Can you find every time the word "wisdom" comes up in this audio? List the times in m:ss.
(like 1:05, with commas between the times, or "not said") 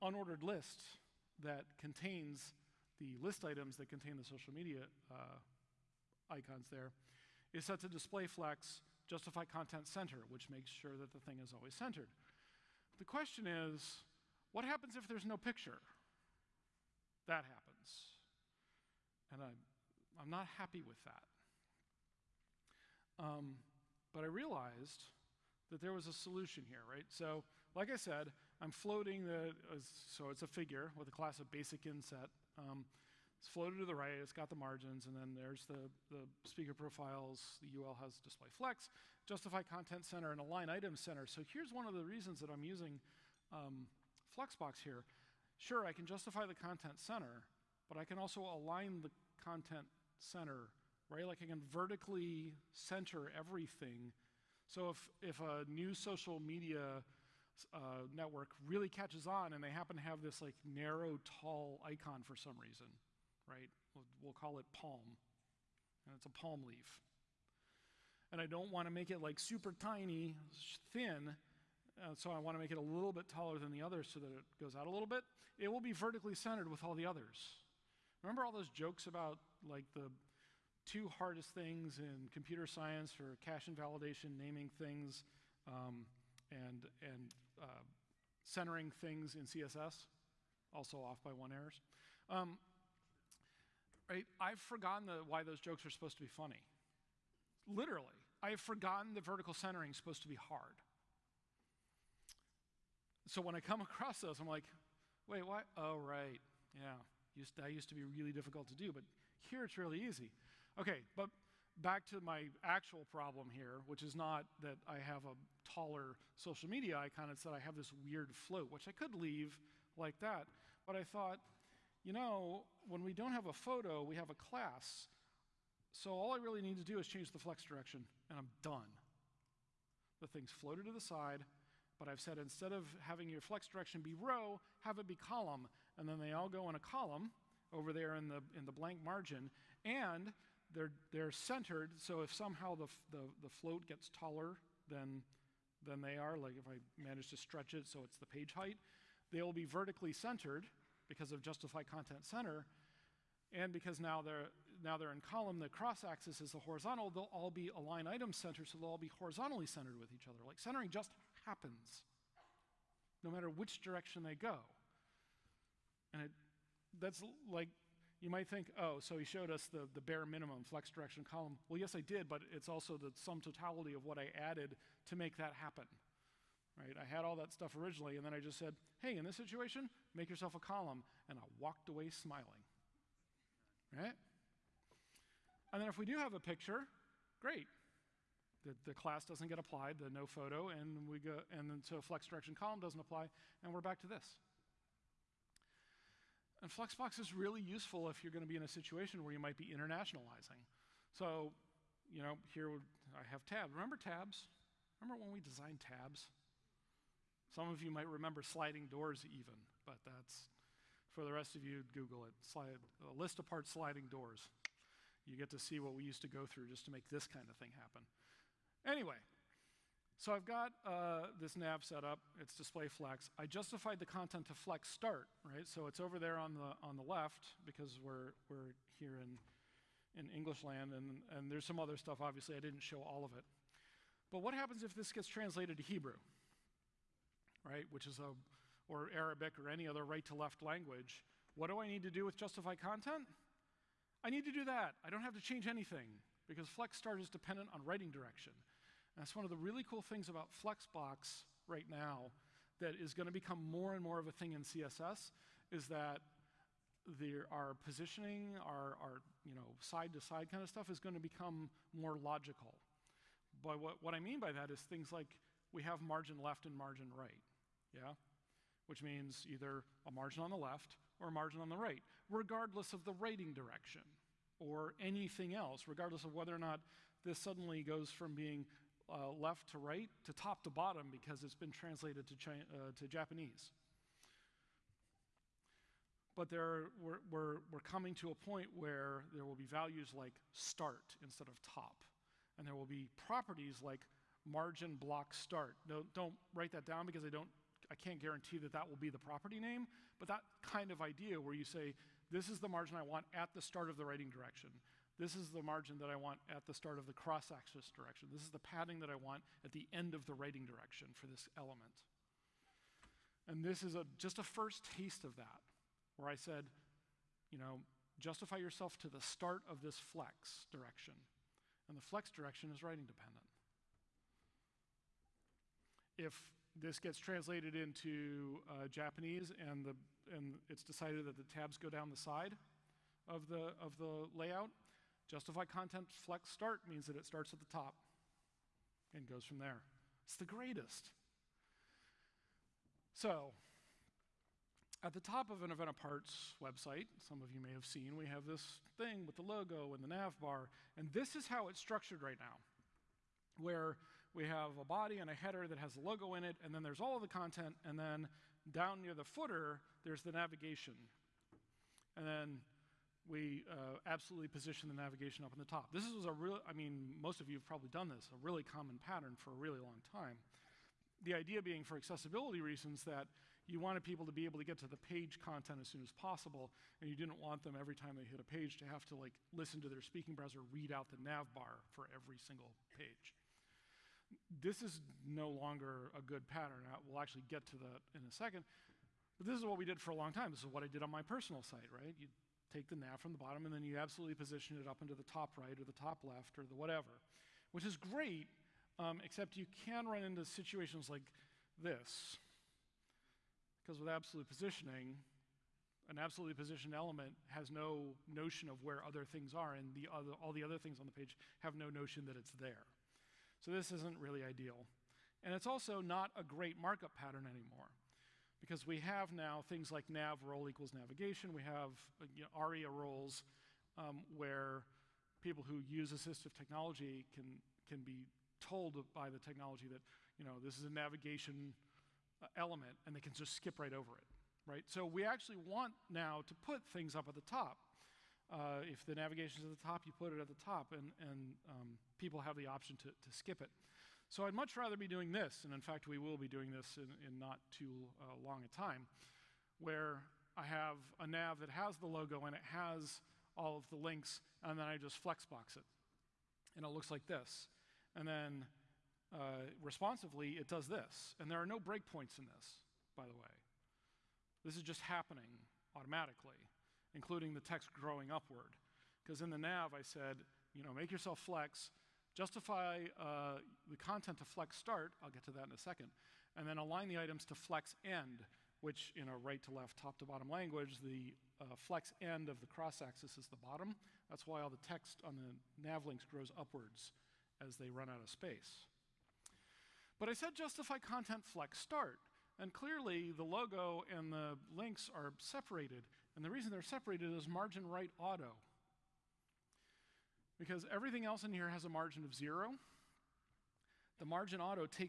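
not said.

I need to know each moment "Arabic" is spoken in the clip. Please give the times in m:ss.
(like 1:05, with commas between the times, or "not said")
3:59.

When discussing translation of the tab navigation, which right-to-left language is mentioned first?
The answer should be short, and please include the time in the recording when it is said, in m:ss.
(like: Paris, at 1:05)
Hebrew, at 3:55.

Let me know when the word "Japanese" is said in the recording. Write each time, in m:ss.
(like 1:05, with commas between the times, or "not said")
4:43, 5:28.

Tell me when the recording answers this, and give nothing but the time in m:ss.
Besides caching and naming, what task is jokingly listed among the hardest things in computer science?
1:28.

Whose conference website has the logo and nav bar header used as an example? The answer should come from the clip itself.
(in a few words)
An Event Apart.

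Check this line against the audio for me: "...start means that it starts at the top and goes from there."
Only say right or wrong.
right.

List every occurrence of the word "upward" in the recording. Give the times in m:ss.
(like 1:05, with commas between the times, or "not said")
7:48, 8:06.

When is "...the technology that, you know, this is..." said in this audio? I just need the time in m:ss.
7:09.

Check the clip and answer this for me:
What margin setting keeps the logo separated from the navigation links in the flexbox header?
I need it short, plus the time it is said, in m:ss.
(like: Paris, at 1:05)
margin right auto, at 8:17.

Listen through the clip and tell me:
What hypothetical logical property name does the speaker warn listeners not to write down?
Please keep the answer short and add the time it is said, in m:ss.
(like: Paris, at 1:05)
margin block start, at 4:54.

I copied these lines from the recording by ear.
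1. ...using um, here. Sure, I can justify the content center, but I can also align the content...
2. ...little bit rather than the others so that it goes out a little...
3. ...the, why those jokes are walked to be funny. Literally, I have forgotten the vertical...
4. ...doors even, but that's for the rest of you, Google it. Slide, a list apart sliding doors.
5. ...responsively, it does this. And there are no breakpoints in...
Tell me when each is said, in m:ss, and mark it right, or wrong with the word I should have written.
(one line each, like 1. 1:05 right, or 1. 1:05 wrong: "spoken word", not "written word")
1. 0:42 right
2. 1:12 wrong: "taller", not "rather"
3. 1:35 wrong: "supposed", not "walked"
4. 3:28 right
5. 7:39 right.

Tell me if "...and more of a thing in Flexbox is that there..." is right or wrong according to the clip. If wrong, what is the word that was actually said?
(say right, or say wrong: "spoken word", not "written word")
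wrong: "CSS", not "Flexbox".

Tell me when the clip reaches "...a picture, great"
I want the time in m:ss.
3:06.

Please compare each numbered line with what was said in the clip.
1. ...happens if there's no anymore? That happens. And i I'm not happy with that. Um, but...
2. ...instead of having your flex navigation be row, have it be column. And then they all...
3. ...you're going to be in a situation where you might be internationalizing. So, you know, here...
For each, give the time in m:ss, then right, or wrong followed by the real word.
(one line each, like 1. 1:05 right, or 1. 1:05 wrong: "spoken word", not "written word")
1. 0:14 wrong: "picture", not "anymore"
2. 2:12 wrong: "direction", not "navigation"
3. 3:18 right.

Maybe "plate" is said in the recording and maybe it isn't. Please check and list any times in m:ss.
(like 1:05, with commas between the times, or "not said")
not said.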